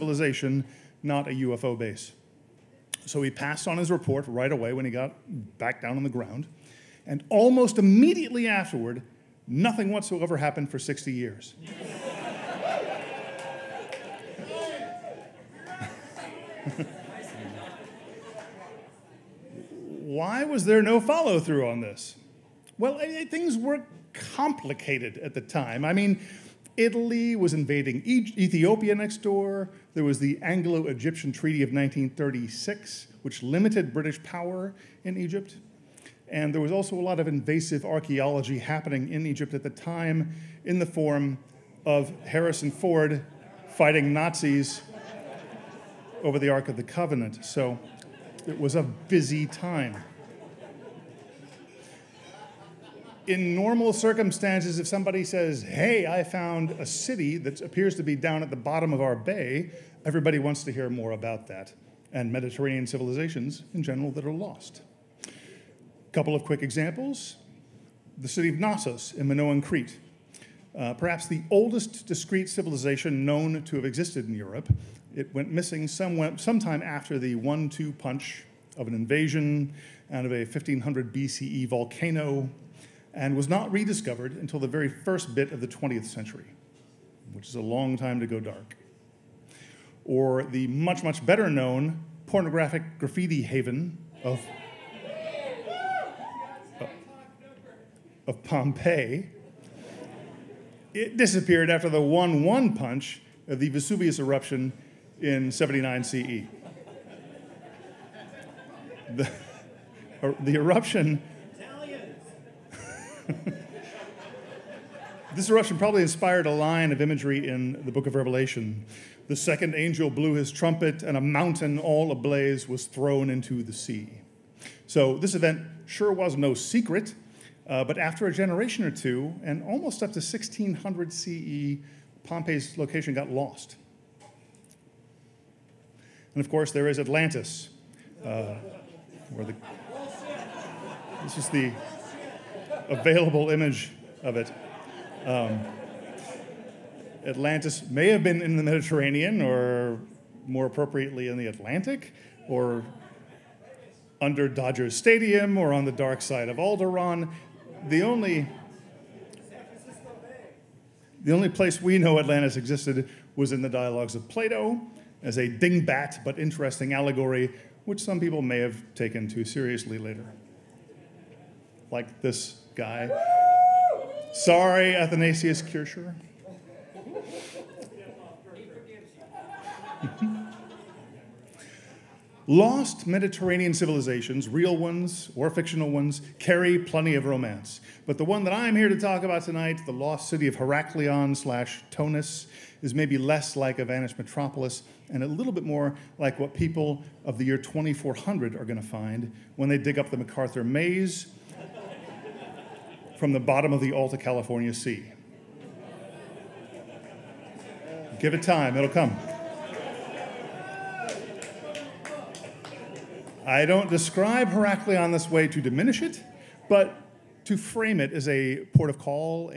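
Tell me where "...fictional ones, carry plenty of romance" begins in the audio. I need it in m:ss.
3:05.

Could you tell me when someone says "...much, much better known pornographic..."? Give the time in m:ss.
1:30.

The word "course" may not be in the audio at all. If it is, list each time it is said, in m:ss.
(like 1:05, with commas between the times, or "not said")
2:16.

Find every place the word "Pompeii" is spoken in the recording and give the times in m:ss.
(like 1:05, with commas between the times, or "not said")
1:38, 2:12.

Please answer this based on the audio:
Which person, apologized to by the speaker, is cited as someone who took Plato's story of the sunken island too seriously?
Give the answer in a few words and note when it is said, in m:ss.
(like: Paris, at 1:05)
Athanasius Kircher, at 2:54.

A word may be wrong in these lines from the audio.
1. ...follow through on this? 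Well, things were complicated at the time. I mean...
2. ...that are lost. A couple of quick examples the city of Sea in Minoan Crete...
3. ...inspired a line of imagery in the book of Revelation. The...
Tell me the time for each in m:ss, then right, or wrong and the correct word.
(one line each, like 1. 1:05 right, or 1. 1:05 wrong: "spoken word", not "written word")
1. 0:21 right
2. 1:04 wrong: "Knossos", not "Sea"
3. 1:56 right.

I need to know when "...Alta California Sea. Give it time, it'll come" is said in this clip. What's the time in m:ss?
3:23.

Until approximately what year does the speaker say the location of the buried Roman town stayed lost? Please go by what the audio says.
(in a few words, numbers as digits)
1600 CE.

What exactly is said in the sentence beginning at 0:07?
And almost immediately afterward, nothing whatsoever happened for 60 years.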